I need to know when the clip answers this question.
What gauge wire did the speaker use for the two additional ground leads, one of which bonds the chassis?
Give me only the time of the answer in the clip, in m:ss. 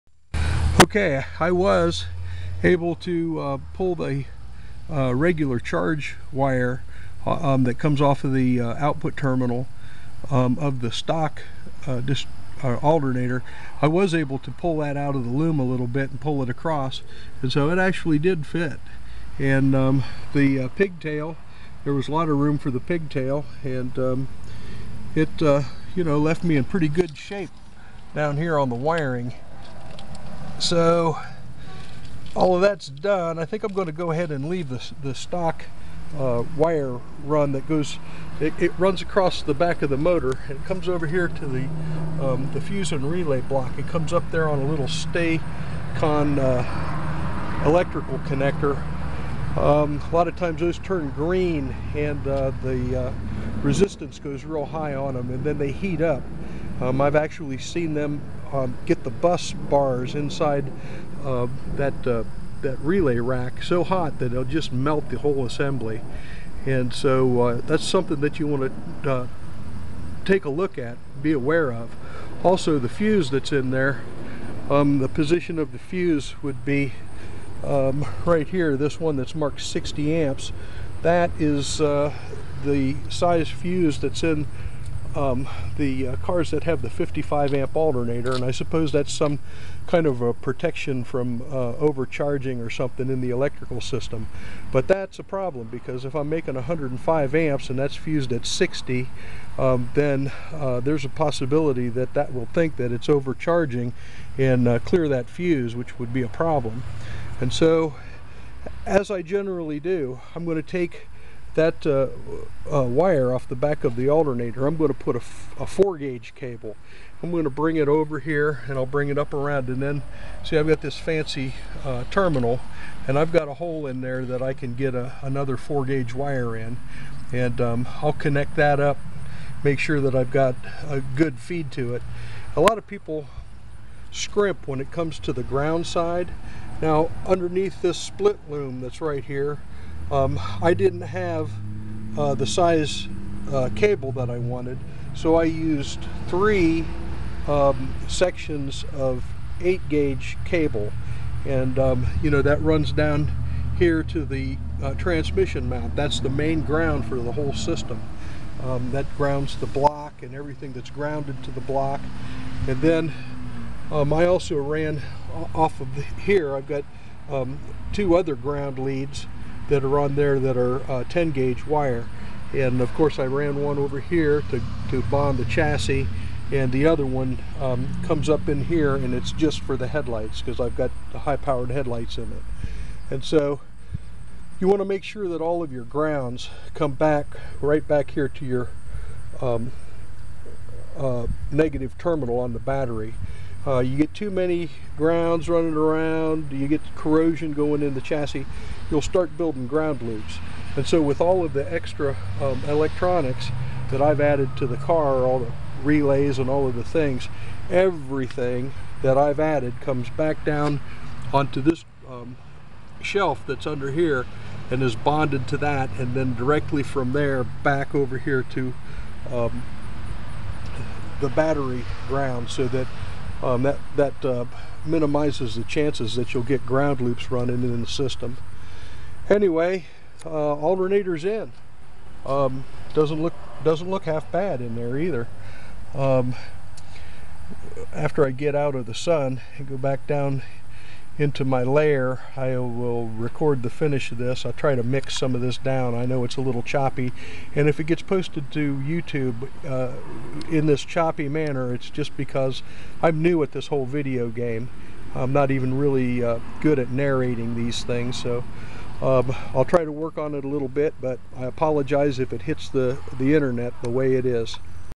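2:51.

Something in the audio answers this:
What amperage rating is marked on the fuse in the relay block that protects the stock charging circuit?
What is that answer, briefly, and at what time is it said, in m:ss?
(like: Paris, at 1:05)
60 amps, at 1:19.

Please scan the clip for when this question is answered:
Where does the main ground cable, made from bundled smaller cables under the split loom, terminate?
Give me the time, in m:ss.
2:34.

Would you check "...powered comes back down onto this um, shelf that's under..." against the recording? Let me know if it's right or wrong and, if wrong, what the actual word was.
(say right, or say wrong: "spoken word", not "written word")
wrong: "added", not "powered".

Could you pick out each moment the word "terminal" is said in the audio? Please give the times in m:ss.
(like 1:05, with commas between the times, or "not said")
0:09, 2:02, 3:11.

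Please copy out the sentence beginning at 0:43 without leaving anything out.
It comes up there on a little stay uh, electrical connector.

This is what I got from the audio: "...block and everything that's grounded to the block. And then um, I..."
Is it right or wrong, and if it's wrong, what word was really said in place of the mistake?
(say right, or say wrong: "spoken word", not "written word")
right.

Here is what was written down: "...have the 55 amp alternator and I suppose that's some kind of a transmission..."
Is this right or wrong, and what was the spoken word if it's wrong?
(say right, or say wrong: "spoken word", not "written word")
wrong: "protection", not "transmission".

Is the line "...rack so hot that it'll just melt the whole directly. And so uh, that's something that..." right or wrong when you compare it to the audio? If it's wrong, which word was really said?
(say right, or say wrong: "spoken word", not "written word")
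wrong: "assembly", not "directly".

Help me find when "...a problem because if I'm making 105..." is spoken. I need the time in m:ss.
1:35.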